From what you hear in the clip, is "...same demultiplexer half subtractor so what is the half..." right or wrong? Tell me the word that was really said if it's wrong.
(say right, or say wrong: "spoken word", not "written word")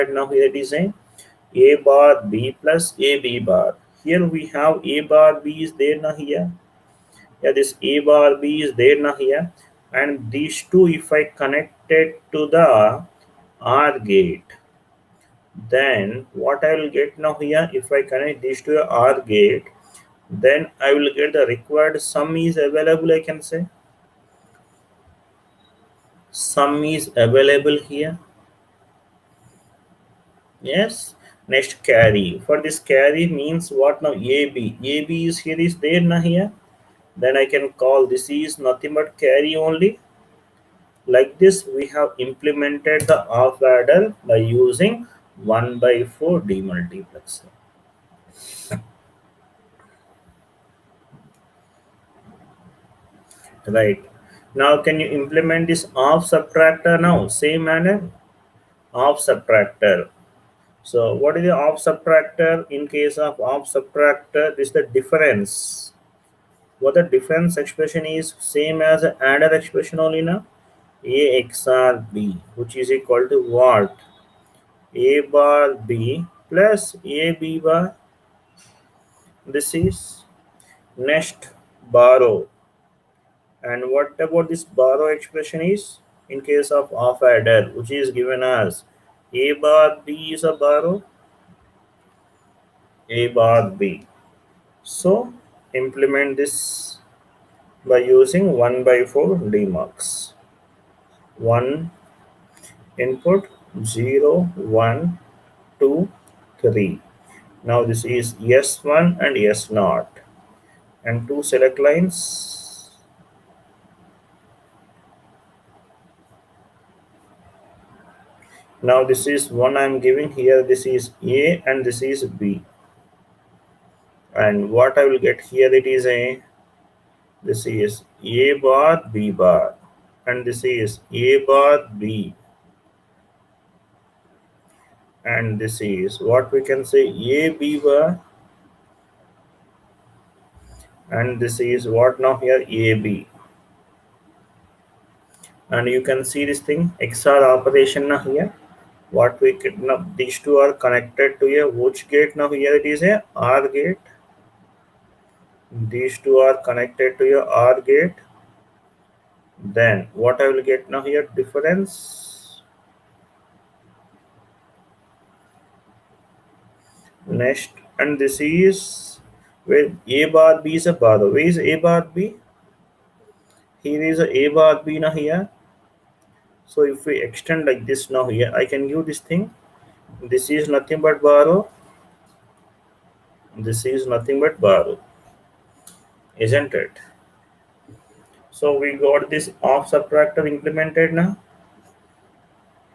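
wrong: "manner", not "demultiplexer".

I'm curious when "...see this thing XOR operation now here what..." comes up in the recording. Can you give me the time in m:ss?
2:26.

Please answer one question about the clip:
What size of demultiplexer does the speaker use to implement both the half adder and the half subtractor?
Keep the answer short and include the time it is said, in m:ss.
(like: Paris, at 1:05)
1 by 4, at 0:45.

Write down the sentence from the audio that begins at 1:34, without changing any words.
So implement this by using 1 by 4 demux.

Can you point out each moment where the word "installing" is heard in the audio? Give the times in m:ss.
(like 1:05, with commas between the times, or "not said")
not said.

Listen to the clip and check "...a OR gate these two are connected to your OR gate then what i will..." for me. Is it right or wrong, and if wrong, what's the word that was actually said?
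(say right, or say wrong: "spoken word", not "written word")
right.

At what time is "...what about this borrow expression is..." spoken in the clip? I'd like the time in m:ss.
1:23.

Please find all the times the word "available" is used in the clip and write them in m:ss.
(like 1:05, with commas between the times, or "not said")
0:22, 0:27.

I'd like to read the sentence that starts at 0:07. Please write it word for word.
Yeah, this A bar B is there now here.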